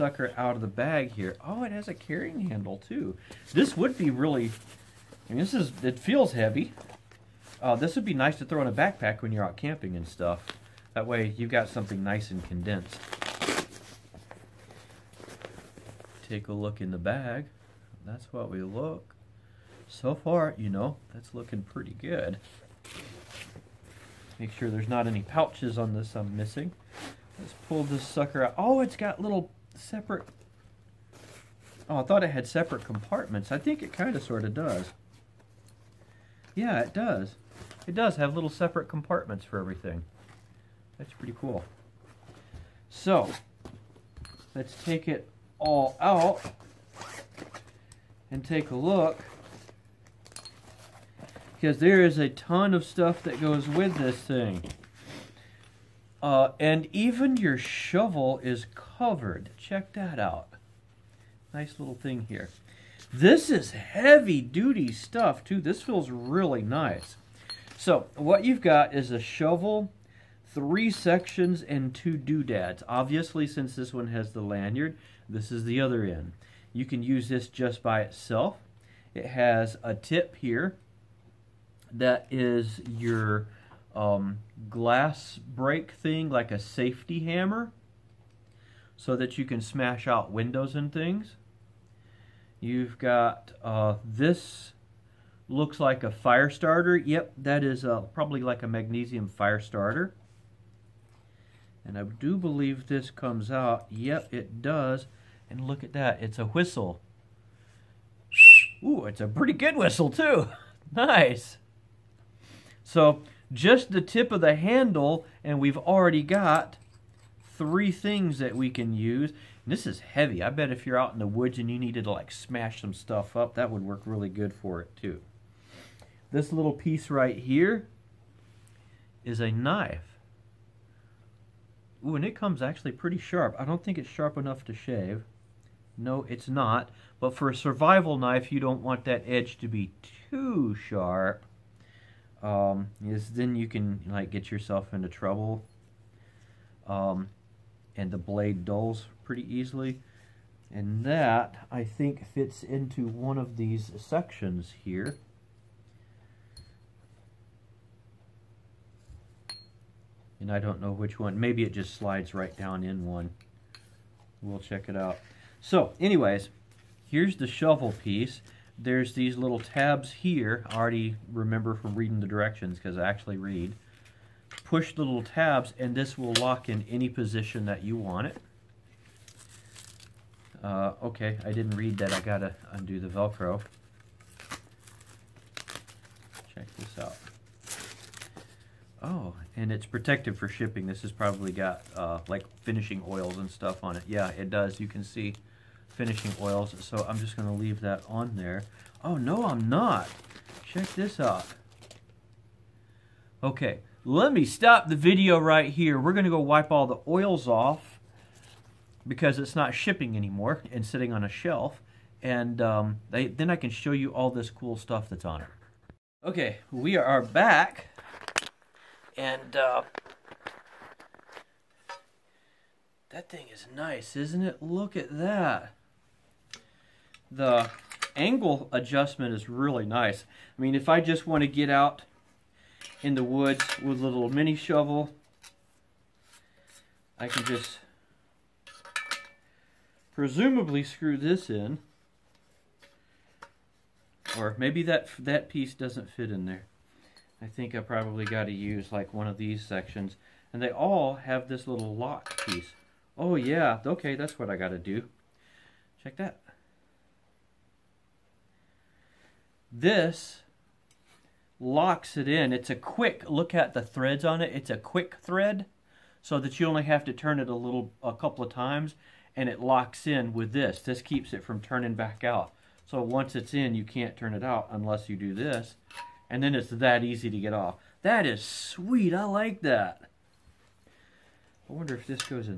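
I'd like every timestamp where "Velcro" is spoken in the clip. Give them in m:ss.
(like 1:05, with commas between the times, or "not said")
3:03.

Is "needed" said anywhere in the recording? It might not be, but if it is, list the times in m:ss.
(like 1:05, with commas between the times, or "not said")
2:01.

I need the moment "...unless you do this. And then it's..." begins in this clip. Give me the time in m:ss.
4:34.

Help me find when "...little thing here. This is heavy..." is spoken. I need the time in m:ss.
1:01.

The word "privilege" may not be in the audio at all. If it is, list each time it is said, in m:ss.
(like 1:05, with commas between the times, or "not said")
not said.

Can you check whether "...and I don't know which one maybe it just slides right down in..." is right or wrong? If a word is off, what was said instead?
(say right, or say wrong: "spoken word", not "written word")
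right.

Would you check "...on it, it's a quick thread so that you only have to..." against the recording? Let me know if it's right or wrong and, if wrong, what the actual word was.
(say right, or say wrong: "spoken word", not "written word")
right.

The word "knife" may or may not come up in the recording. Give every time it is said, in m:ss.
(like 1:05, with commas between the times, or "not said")
2:09, 2:18.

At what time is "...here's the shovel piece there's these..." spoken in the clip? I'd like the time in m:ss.
2:47.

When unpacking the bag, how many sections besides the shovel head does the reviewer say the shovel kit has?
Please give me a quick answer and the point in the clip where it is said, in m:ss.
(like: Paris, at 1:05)
3, at 1:10.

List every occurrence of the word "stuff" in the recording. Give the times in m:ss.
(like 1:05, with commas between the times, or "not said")
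0:10, 0:52, 1:04, 2:02, 3:13, 3:34.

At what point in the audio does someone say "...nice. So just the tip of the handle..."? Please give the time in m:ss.
1:50.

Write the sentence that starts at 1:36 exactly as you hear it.
Yep, that is uh, probably like a magnesium fire starter.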